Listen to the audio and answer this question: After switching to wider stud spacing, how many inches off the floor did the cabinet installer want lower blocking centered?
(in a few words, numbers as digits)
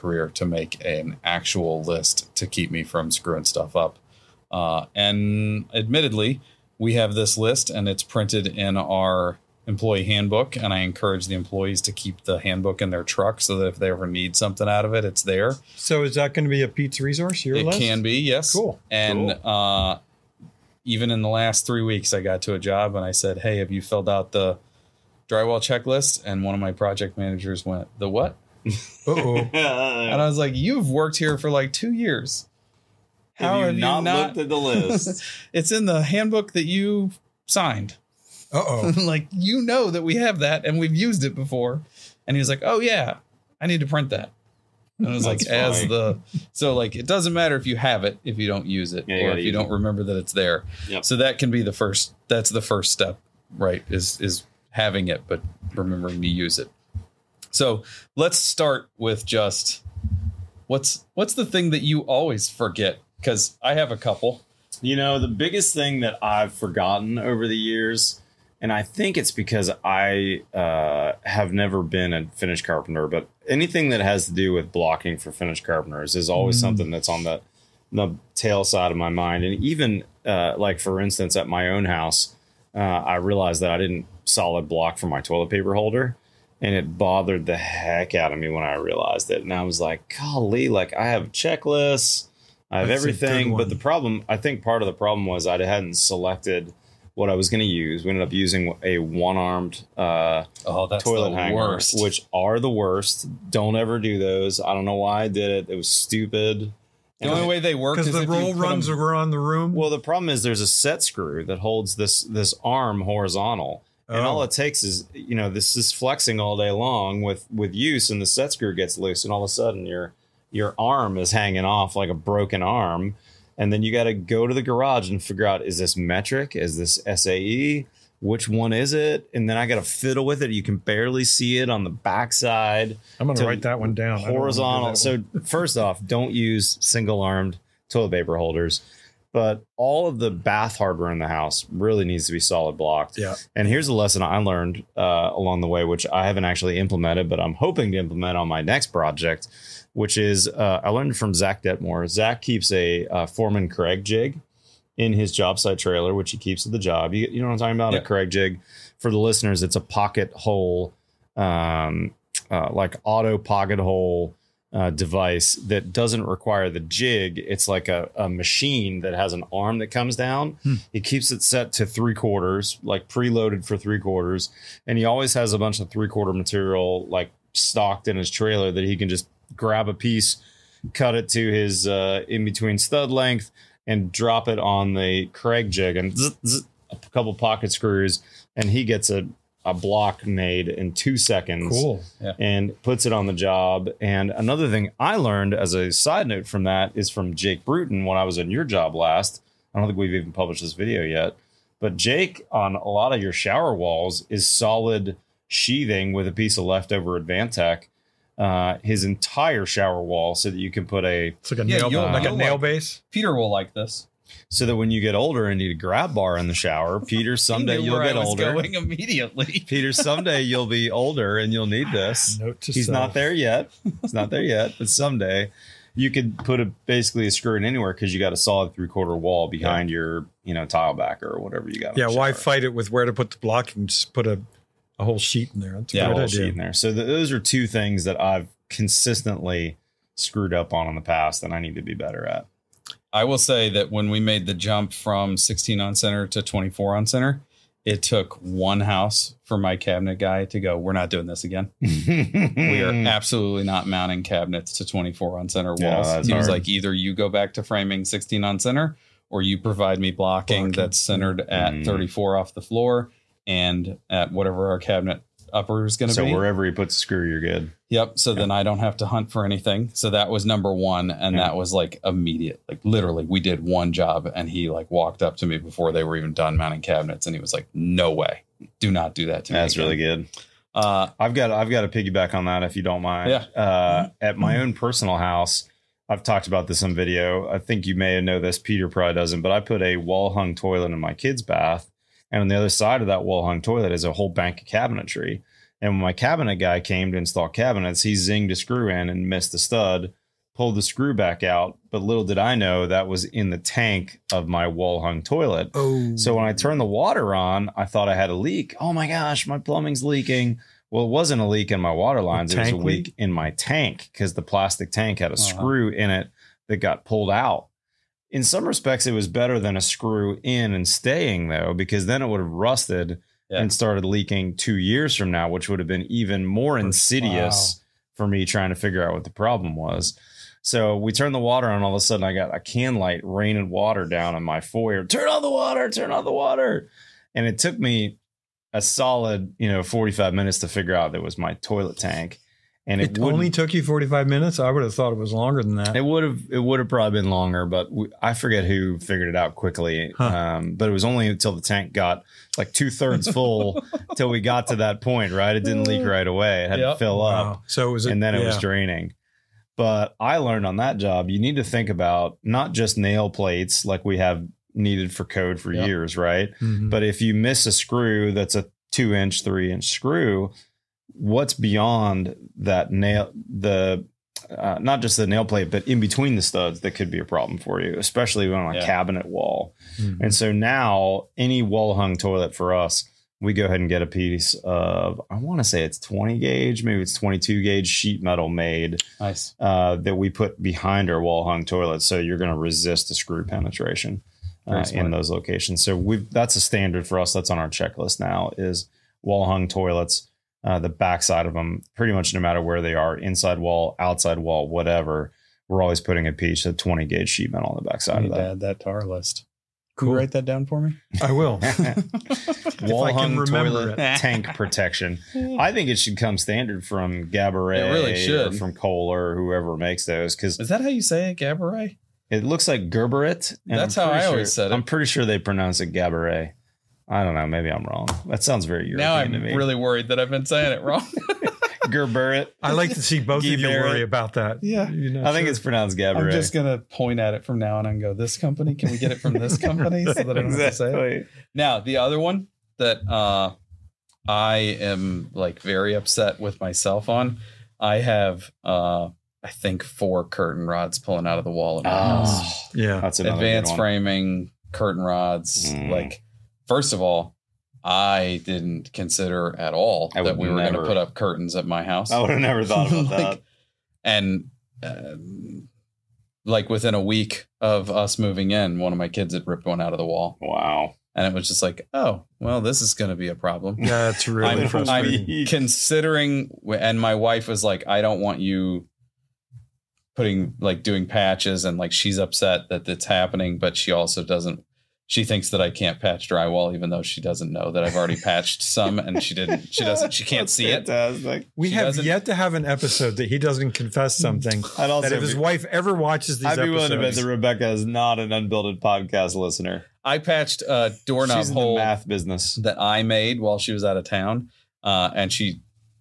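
34.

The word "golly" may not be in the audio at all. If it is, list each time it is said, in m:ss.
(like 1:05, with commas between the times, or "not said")
1:30.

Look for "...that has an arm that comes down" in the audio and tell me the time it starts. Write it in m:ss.
2:48.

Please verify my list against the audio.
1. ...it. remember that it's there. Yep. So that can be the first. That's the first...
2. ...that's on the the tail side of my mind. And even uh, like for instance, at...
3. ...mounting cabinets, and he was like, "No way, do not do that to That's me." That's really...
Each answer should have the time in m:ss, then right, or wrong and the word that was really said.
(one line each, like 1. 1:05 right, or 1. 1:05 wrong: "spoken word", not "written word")
1. 0:49 right
2. 1:16 right
3. 4:36 right.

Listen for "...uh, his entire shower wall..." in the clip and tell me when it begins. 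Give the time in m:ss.
3:28.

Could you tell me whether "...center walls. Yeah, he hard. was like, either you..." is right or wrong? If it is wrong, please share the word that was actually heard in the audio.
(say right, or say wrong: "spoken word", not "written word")
right.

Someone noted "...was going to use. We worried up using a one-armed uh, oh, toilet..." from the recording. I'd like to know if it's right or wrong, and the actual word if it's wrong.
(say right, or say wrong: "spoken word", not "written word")
wrong: "ended", not "worried".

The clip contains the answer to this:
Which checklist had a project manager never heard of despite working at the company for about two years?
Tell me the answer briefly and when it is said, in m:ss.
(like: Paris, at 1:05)
Drywall checklist, at 0:25.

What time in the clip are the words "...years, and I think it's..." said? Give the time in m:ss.
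1:07.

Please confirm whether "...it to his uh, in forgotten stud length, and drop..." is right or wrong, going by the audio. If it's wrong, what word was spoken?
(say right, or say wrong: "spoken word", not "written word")
wrong: "between", not "forgotten".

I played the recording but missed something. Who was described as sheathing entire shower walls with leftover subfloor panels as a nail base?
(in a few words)
Jake Bruton.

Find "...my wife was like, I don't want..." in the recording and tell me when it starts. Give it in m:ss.
7:56.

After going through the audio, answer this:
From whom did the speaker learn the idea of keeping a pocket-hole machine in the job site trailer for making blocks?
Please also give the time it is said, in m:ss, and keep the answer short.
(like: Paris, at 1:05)
Zach Dettmore, at 2:31.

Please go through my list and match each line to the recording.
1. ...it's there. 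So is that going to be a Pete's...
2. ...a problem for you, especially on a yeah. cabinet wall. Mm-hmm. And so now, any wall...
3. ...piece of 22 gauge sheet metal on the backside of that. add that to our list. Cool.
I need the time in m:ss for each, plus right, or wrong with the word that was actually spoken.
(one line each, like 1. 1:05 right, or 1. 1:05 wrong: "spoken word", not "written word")
1. 0:15 right
2. 6:17 right
3. 6:46 wrong: "20", not "22".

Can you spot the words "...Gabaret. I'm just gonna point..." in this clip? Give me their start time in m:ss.
7:15.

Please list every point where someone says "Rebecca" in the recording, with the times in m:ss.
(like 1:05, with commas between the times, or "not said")
8:17.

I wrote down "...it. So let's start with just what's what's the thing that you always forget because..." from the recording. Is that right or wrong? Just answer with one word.
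right.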